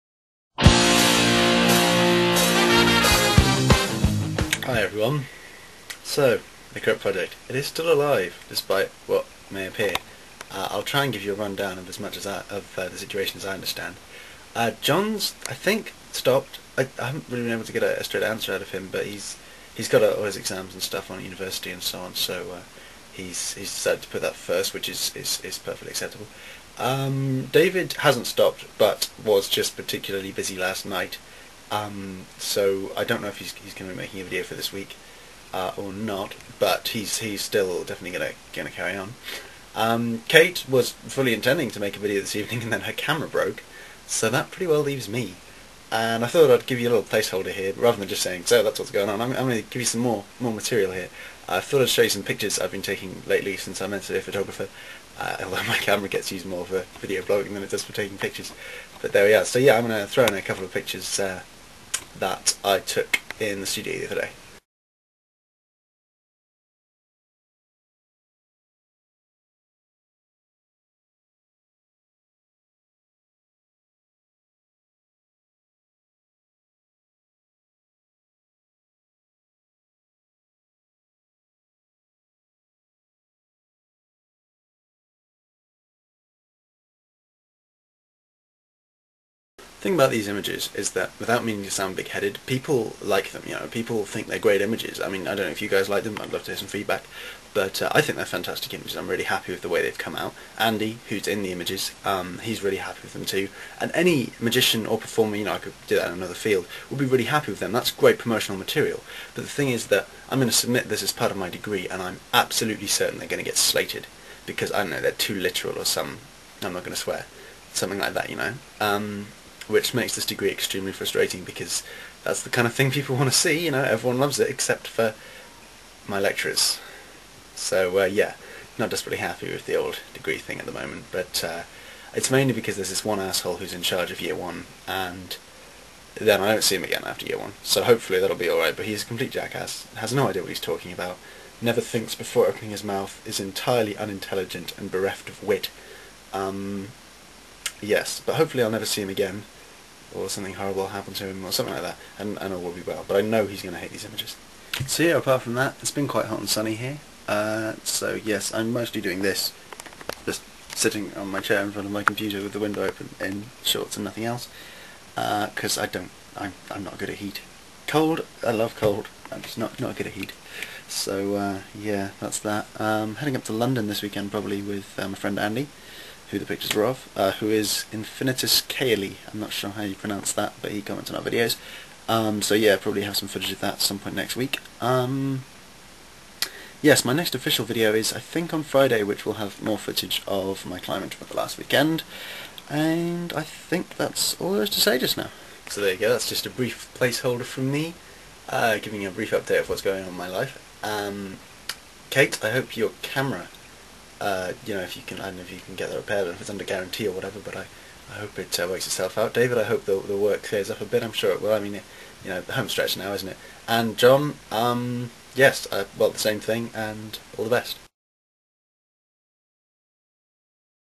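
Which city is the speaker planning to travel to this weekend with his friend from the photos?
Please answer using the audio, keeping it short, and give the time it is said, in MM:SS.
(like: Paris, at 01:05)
London, at 02:53.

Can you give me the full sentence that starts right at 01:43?
And any magician or performer, you know, I could do that in another field, would be really happy with them.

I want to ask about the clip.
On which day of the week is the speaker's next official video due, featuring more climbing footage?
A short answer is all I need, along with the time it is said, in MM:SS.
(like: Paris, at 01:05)
Friday, at 03:08.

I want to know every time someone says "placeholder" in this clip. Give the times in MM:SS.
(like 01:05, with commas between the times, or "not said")
00:47, 03:16.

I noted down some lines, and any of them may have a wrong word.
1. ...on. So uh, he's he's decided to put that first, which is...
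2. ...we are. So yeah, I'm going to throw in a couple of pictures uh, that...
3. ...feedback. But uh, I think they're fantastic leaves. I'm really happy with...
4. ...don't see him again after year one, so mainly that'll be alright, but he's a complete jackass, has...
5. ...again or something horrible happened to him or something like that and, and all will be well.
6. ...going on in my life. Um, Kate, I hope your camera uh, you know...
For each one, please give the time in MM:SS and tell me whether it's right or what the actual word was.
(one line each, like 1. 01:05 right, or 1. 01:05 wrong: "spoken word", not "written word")
1. 00:21 right
2. 00:59 right
3. 01:36 wrong: "images", not "leaves"
4. 02:16 wrong: "hopefully", not "mainly"
5. 02:29 right
6. 03:19 right.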